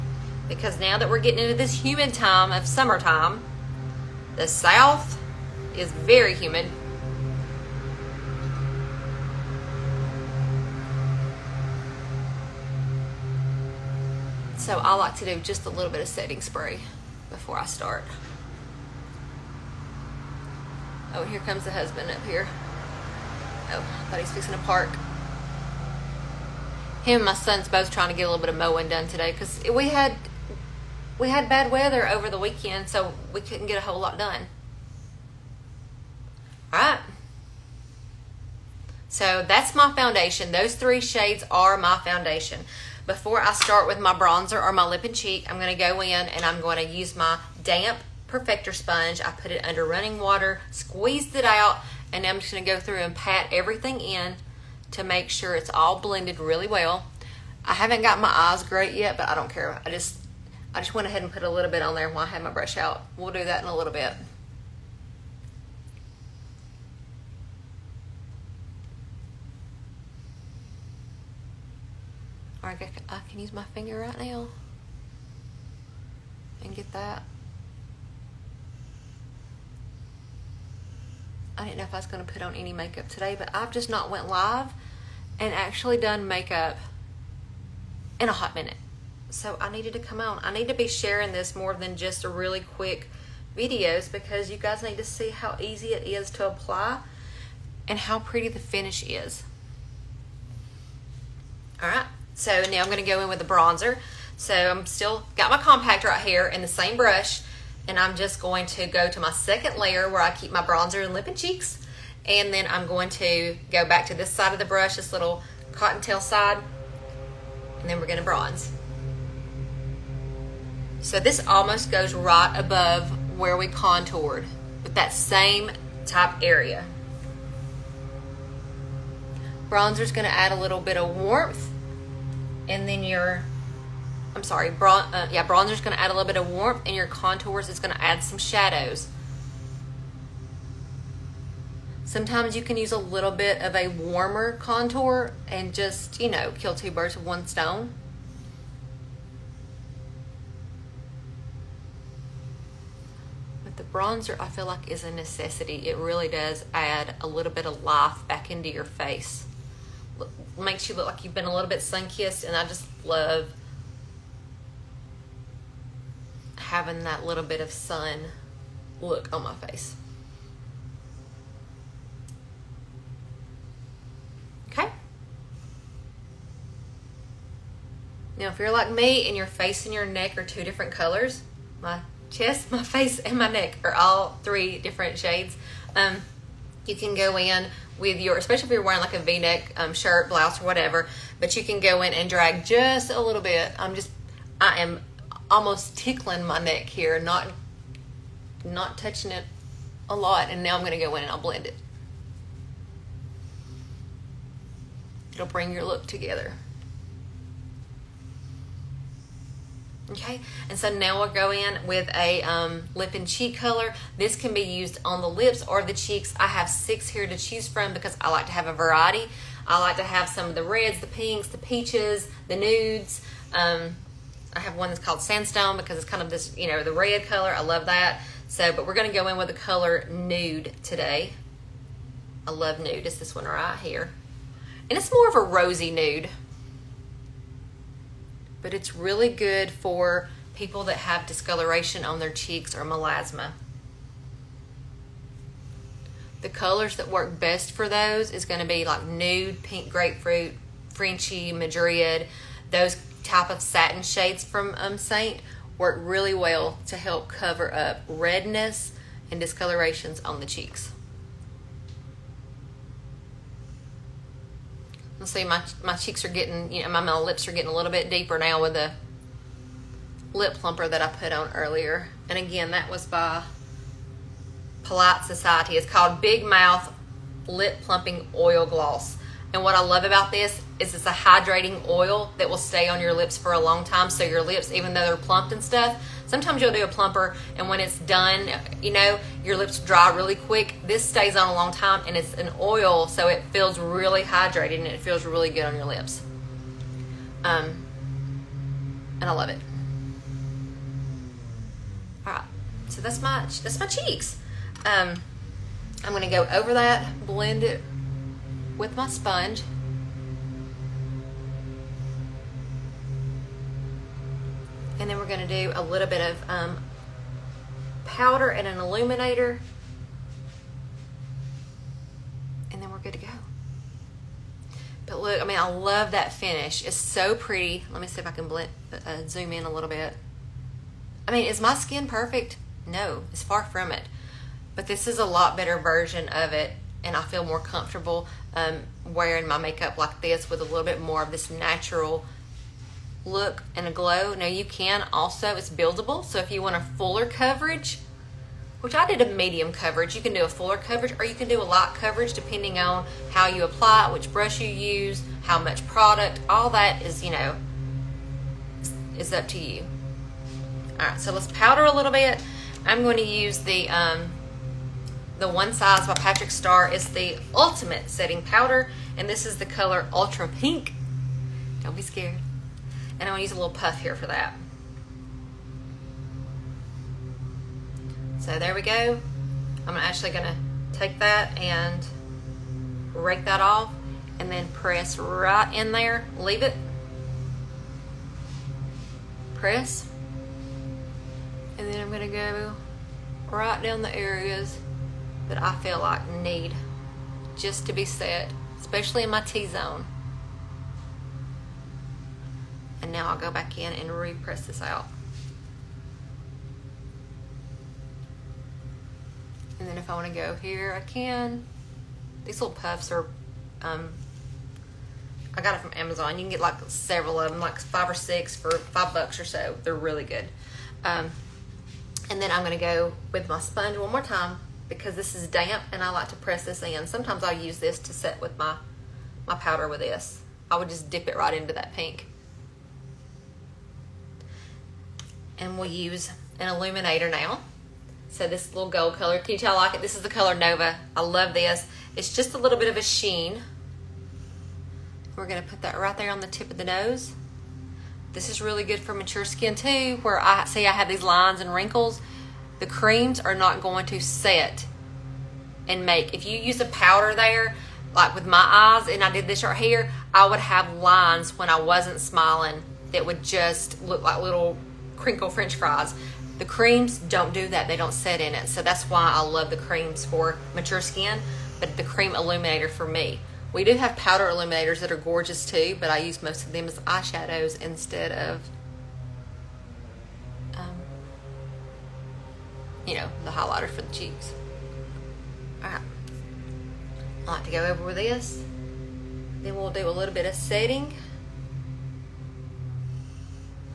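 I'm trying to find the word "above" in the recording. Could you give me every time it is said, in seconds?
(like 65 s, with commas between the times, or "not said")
122 s.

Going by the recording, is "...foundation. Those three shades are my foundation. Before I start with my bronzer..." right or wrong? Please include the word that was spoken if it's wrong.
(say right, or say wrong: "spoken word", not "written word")
right.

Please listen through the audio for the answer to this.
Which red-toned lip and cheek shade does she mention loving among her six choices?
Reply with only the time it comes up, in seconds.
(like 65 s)
225 s.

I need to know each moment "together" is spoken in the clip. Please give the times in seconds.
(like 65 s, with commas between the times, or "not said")
206 s.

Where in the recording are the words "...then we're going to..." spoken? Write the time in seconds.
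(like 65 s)
117 s.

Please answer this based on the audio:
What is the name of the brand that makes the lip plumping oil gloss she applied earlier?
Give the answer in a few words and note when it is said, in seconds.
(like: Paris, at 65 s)
Polite Society, at 274 s.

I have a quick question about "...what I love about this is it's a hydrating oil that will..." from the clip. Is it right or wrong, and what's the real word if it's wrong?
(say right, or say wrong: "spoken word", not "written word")
right.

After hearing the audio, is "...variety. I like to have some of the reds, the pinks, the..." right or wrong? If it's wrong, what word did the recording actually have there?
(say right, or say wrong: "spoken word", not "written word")
right.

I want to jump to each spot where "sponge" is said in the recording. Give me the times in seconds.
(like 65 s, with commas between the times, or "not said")
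48 s, 309 s, 423 s.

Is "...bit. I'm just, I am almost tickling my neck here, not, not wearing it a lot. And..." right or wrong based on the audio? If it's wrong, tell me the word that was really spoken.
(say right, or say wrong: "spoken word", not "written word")
wrong: "touching", not "wearing".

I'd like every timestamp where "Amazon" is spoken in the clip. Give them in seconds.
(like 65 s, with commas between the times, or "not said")
415 s.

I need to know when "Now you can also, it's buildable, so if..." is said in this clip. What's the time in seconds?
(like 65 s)
344 s.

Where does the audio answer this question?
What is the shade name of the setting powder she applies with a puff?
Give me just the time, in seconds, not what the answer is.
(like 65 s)
370 s.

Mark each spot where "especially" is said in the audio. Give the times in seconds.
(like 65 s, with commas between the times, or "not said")
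188 s, 398 s.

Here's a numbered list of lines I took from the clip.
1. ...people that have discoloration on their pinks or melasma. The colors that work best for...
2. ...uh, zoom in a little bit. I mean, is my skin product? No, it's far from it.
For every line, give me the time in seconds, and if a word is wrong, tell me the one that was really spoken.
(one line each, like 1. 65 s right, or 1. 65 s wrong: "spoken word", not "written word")
1. 240 s wrong: "cheeks", not "pinks"
2. 329 s wrong: "perfect", not "product".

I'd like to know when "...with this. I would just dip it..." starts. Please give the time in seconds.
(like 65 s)
429 s.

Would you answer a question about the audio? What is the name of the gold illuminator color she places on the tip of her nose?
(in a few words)
Nova.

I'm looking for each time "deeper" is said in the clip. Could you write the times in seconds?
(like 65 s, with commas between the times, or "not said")
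268 s.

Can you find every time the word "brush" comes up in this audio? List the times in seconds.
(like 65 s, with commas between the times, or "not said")
62 s, 106 s, 114 s, 354 s.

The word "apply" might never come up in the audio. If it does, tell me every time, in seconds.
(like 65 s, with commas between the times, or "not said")
96 s, 353 s.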